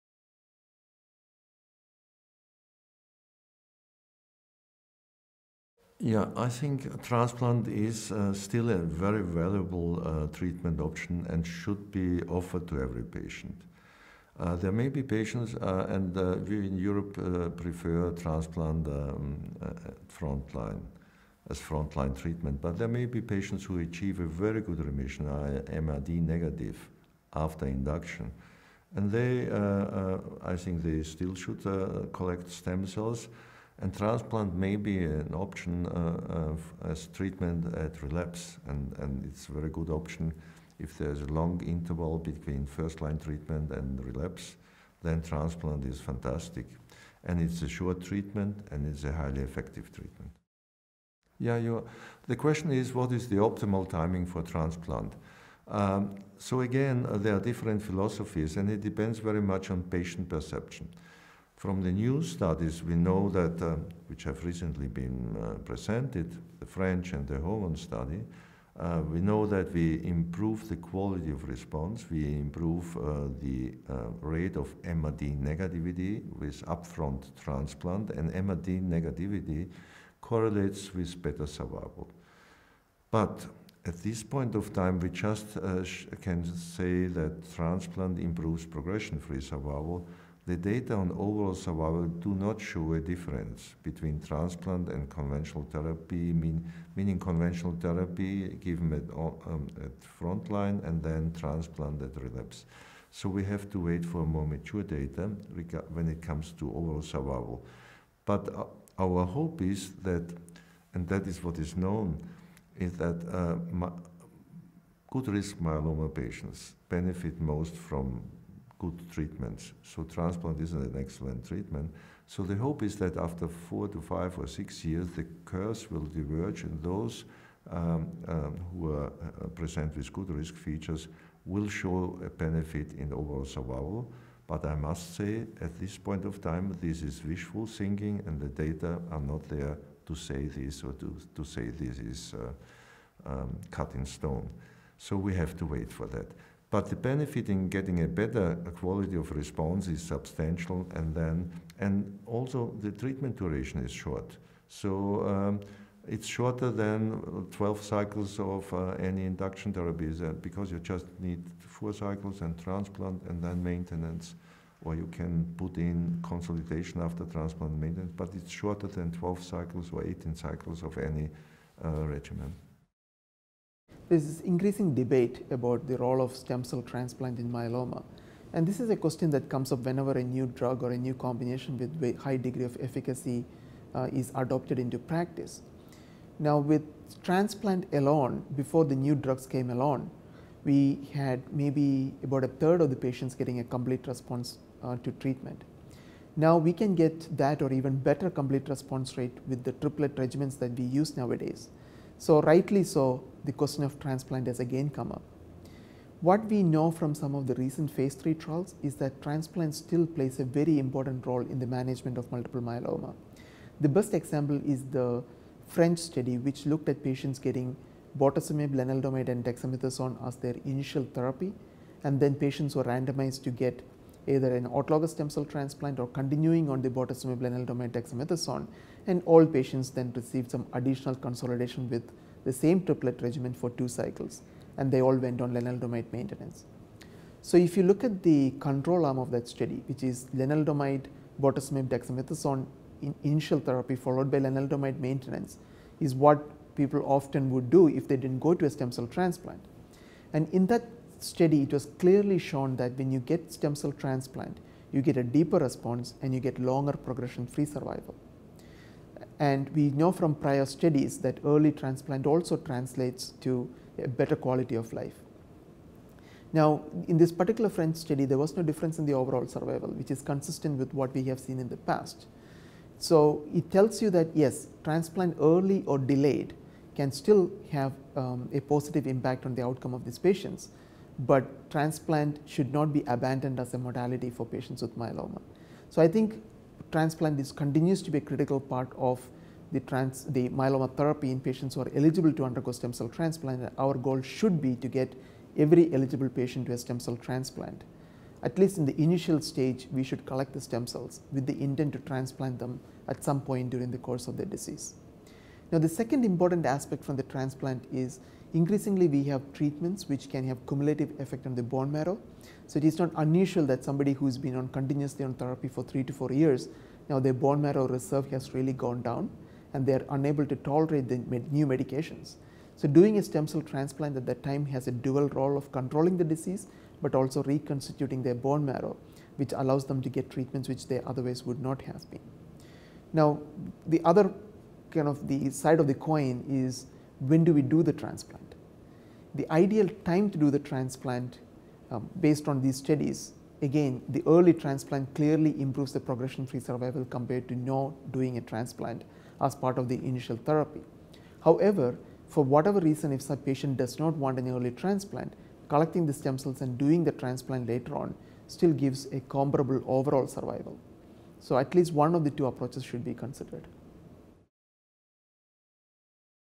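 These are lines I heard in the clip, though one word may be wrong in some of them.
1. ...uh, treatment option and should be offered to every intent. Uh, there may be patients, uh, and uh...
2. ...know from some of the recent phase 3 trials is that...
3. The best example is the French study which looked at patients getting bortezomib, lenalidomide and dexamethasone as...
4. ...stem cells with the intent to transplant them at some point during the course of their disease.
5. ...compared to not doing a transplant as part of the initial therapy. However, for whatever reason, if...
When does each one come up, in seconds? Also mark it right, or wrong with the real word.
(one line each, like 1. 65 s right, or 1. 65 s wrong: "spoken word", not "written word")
1. 10 s wrong: "patient", not "intent"
2. 206 s right
3. 213 s right
4. 300 s right
5. 347 s right.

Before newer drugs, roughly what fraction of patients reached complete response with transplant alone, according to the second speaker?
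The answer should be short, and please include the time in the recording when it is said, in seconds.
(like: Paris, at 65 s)
a third, at 192 s.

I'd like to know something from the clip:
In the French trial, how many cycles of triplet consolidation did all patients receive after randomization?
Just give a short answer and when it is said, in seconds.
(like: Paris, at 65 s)
2, at 233 s.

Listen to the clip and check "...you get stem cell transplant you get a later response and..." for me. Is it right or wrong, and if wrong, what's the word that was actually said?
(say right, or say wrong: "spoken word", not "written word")
wrong: "deeper", not "later".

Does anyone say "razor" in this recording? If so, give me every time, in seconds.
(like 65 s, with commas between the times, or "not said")
not said.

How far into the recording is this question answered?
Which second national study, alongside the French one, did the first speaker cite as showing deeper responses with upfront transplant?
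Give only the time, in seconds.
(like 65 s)
67 s.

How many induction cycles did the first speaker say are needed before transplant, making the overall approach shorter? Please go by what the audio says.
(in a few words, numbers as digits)
4.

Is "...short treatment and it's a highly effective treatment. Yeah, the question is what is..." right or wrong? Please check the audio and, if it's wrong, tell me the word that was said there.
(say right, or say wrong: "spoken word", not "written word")
right.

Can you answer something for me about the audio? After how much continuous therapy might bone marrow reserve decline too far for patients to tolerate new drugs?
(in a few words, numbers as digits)
3 to 4 years.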